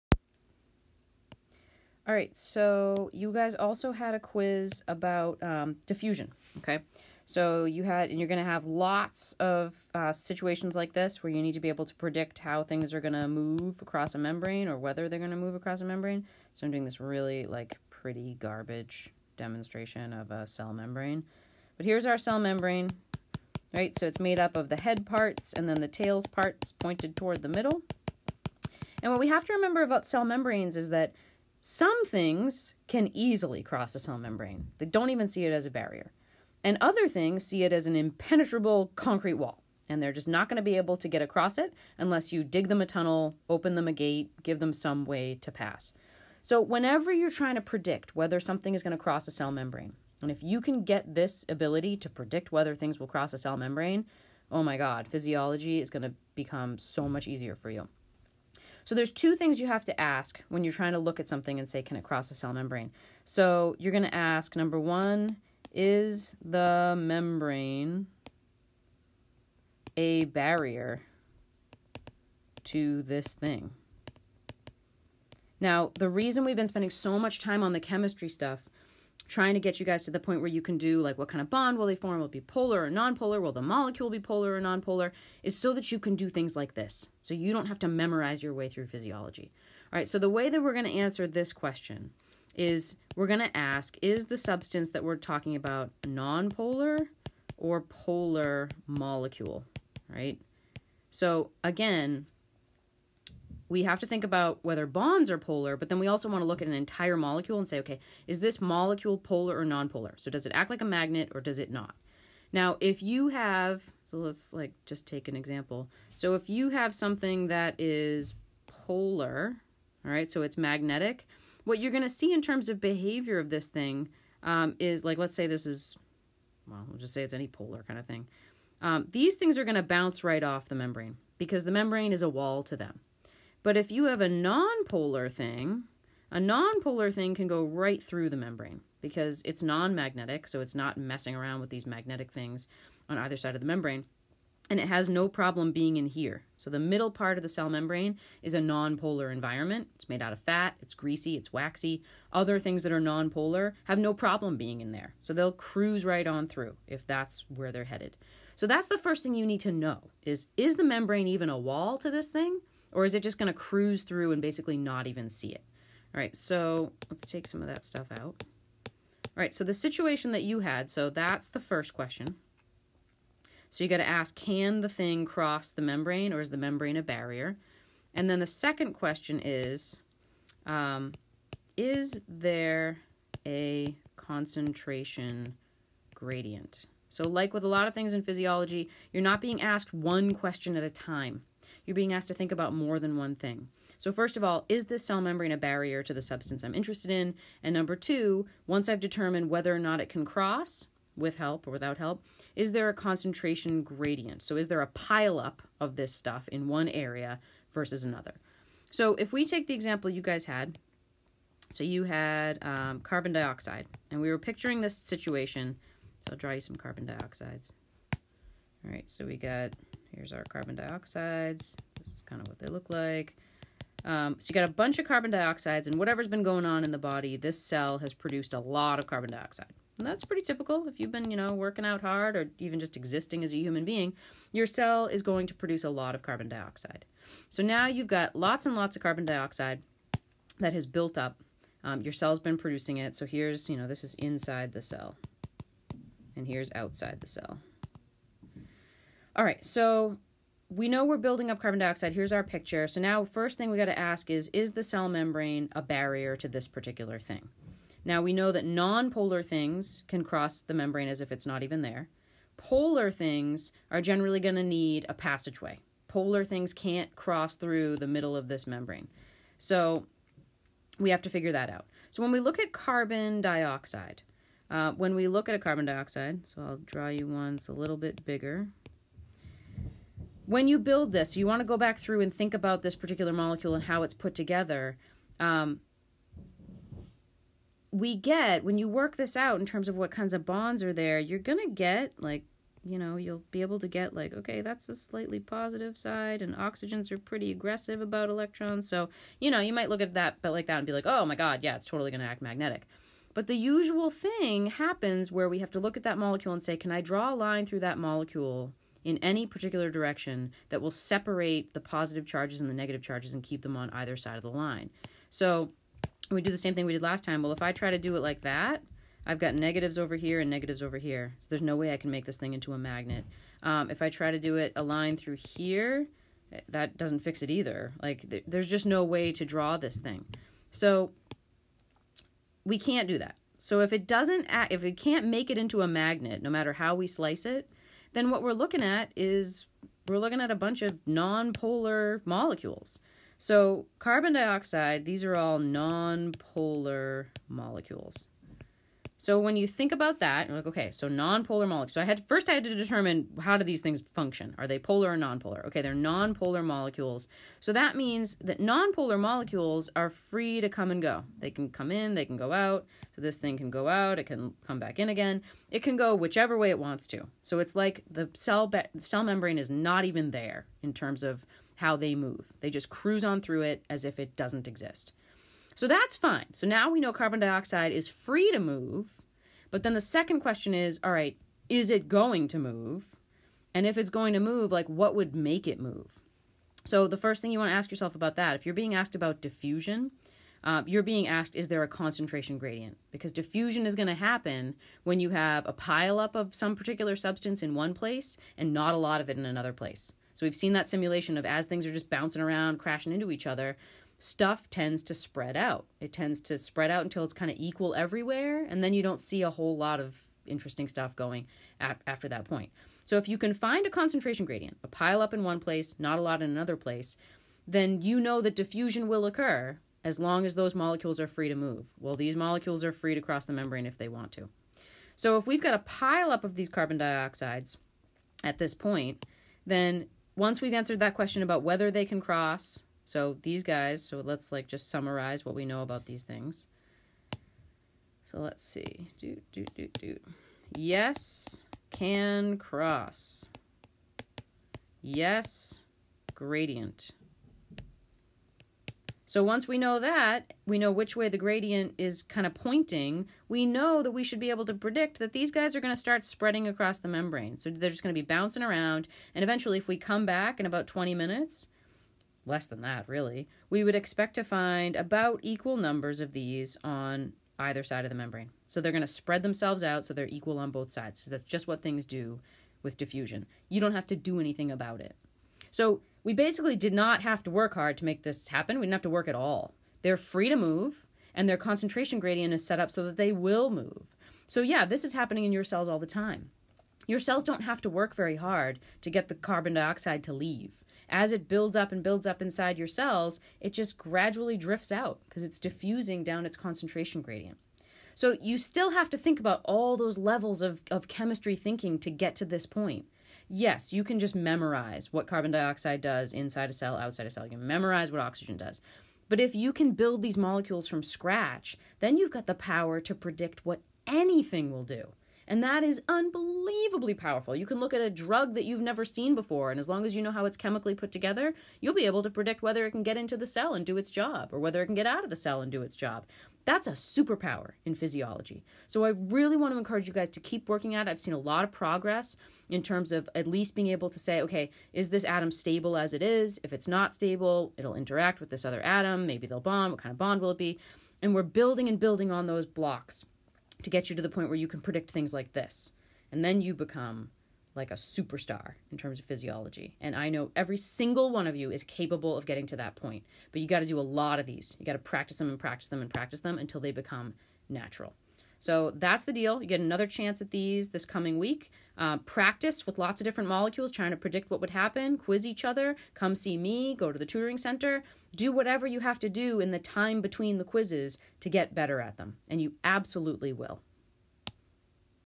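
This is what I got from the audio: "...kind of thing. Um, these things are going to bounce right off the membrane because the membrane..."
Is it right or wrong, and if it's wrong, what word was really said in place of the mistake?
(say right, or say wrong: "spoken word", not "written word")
right.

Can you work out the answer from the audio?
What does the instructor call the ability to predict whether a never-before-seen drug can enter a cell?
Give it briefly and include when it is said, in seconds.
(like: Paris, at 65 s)
a superpower, at 526 s.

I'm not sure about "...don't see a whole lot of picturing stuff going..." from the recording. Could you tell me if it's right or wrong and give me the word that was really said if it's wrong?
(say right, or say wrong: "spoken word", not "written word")
wrong: "interesting", not "picturing".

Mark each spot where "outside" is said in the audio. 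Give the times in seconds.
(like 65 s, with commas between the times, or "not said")
246 s, 506 s.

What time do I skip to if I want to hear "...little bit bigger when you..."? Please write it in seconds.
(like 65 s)
277 s.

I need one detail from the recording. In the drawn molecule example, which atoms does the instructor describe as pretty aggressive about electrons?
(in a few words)
oxygens.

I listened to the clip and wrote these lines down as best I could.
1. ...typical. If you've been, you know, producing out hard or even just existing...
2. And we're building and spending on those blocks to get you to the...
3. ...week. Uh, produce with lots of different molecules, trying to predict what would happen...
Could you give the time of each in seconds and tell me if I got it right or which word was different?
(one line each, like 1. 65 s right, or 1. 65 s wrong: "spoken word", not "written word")
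1. 230 s wrong: "working", not "producing"
2. 541 s wrong: "building", not "spending"
3. 561 s wrong: "practice", not "produce".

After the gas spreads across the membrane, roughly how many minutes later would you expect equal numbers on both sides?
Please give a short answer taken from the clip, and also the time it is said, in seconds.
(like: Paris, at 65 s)
20, at 460 s.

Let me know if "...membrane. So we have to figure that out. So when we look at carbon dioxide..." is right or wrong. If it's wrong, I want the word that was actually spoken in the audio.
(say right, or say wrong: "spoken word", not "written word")
right.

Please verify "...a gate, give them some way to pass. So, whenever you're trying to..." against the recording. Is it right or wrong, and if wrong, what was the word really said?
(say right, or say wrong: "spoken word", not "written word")
right.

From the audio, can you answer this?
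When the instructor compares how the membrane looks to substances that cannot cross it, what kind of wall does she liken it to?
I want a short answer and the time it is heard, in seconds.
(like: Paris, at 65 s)
impenetrable concrete wall, at 37 s.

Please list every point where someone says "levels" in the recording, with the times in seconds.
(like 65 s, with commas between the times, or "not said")
500 s.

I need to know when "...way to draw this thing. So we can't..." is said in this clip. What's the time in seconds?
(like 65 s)
329 s.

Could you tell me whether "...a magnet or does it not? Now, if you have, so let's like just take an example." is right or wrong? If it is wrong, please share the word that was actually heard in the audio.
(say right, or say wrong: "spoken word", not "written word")
right.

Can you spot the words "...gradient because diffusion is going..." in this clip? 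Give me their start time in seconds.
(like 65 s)
392 s.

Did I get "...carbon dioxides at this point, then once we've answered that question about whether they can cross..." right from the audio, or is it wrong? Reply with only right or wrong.
right.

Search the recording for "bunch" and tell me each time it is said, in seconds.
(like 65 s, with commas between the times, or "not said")
224 s, 340 s.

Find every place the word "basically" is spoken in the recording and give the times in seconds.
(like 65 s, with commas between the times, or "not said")
164 s, 476 s.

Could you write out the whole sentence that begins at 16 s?
So I'm doing this really like pretty garbage demonstration of a cell membrane.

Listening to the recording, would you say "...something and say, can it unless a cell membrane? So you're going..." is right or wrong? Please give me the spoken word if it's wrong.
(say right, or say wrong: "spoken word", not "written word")
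wrong: "cross", not "unless".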